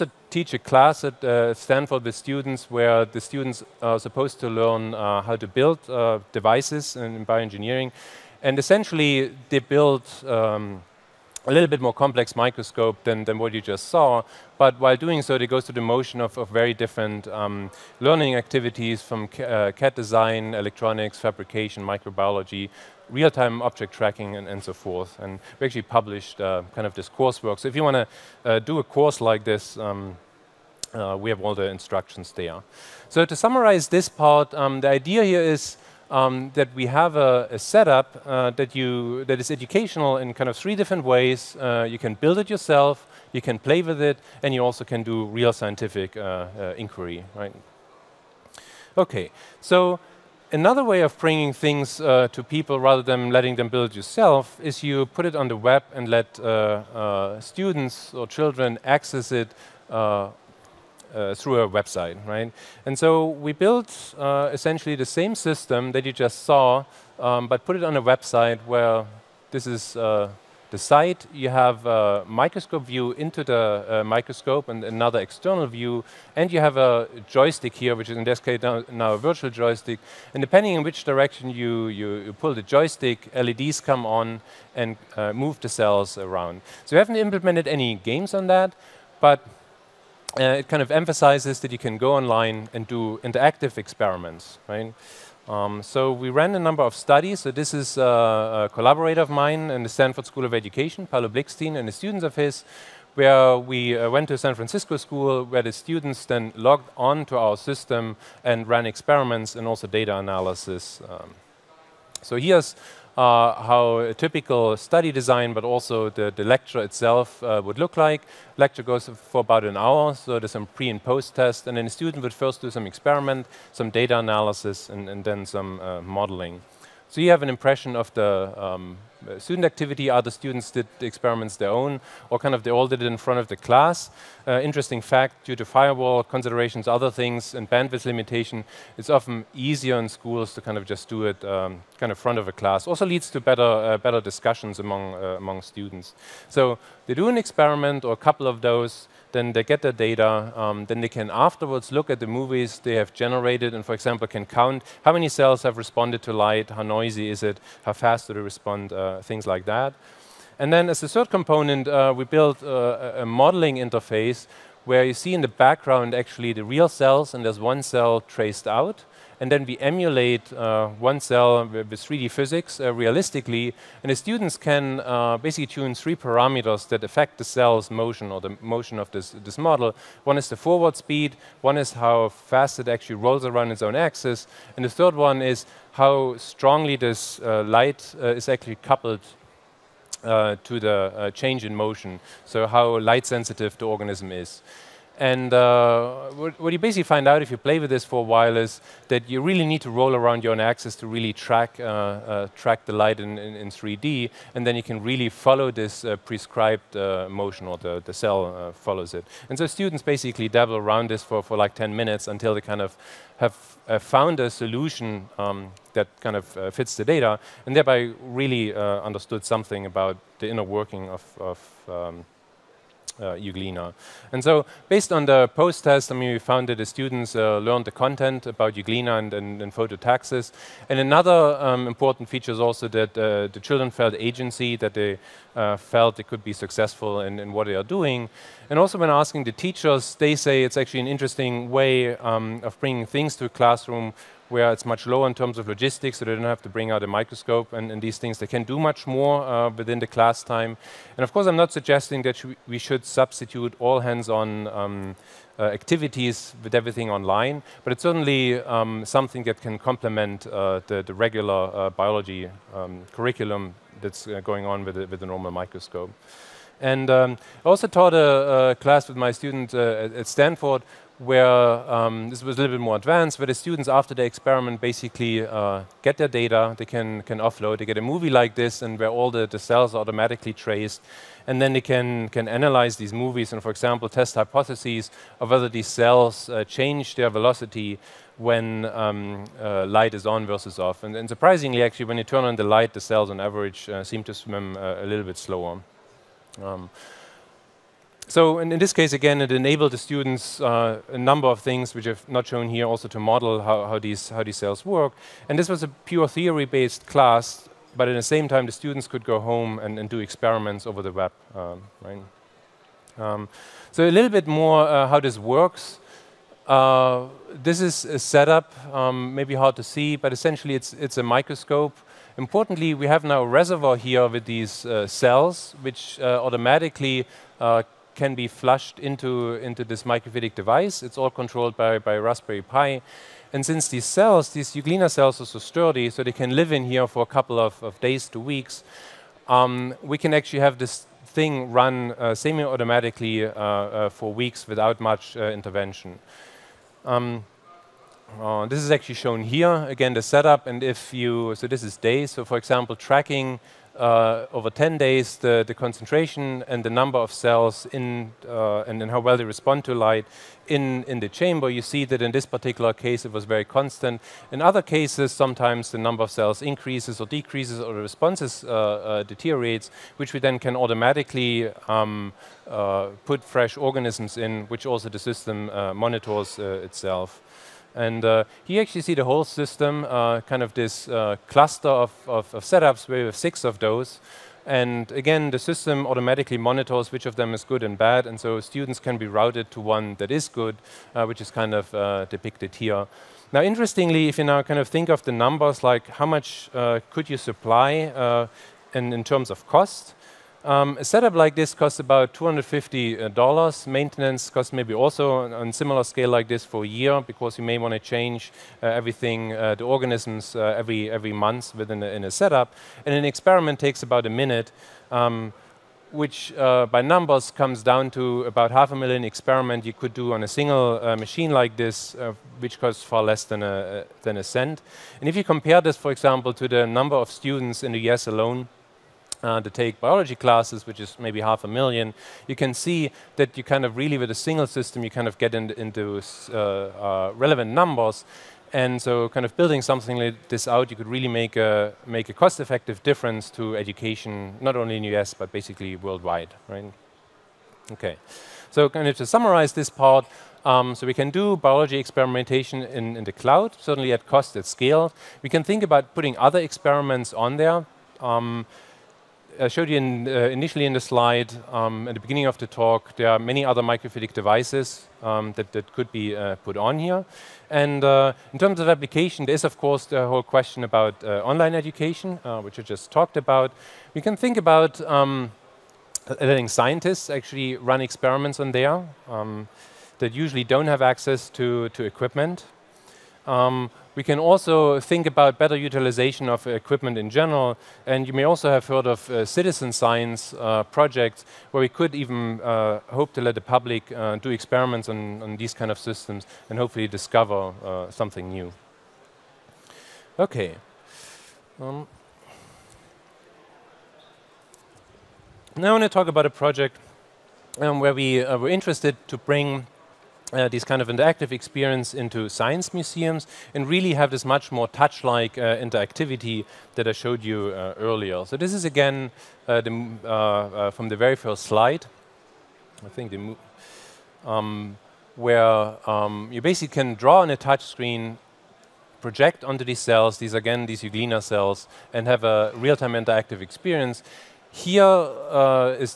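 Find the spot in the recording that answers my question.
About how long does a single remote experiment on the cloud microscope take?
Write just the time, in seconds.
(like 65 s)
414 s.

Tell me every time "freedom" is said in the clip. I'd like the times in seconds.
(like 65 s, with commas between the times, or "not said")
not said.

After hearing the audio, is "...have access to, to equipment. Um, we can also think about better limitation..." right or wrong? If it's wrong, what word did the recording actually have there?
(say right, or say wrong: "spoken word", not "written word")
wrong: "utilization", not "limitation".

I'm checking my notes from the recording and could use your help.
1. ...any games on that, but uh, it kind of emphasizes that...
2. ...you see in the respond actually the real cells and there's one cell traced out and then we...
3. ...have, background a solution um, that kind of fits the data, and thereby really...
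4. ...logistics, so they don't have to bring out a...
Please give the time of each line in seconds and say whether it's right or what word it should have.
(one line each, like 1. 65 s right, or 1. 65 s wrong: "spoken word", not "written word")
1. 87 s right
2. 165 s wrong: "background", not "respond"
3. 213 s wrong: "found", not "background"
4. 245 s right.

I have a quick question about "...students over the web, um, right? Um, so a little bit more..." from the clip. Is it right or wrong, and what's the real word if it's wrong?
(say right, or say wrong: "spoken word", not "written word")
wrong: "experiments", not "students".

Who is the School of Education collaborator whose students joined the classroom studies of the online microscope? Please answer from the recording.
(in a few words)
Paulo Blikstein.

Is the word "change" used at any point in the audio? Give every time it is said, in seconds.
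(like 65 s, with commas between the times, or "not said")
191 s, 286 s, 407 s.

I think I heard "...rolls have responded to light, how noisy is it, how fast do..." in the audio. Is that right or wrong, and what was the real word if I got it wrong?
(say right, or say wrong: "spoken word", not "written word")
wrong: "cells", not "rolls".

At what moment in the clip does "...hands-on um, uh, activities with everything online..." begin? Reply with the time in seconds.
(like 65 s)
253 s.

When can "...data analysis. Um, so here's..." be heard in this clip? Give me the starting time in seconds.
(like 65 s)
109 s.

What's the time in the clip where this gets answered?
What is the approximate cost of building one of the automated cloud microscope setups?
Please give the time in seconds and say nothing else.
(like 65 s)
402 s.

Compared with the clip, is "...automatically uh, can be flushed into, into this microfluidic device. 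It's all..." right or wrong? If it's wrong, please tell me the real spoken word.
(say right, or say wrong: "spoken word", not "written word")
right.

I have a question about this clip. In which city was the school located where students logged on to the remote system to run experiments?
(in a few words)
San Francisco.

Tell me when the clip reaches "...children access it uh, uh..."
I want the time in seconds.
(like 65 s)
58 s.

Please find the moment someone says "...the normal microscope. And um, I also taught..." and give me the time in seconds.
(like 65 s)
265 s.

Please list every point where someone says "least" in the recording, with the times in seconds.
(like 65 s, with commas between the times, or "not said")
not said.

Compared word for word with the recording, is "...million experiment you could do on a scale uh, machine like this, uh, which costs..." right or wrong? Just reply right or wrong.
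wrong.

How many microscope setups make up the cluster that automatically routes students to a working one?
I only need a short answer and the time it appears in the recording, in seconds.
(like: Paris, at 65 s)
6, at 383 s.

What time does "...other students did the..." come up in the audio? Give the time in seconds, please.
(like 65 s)
130 s.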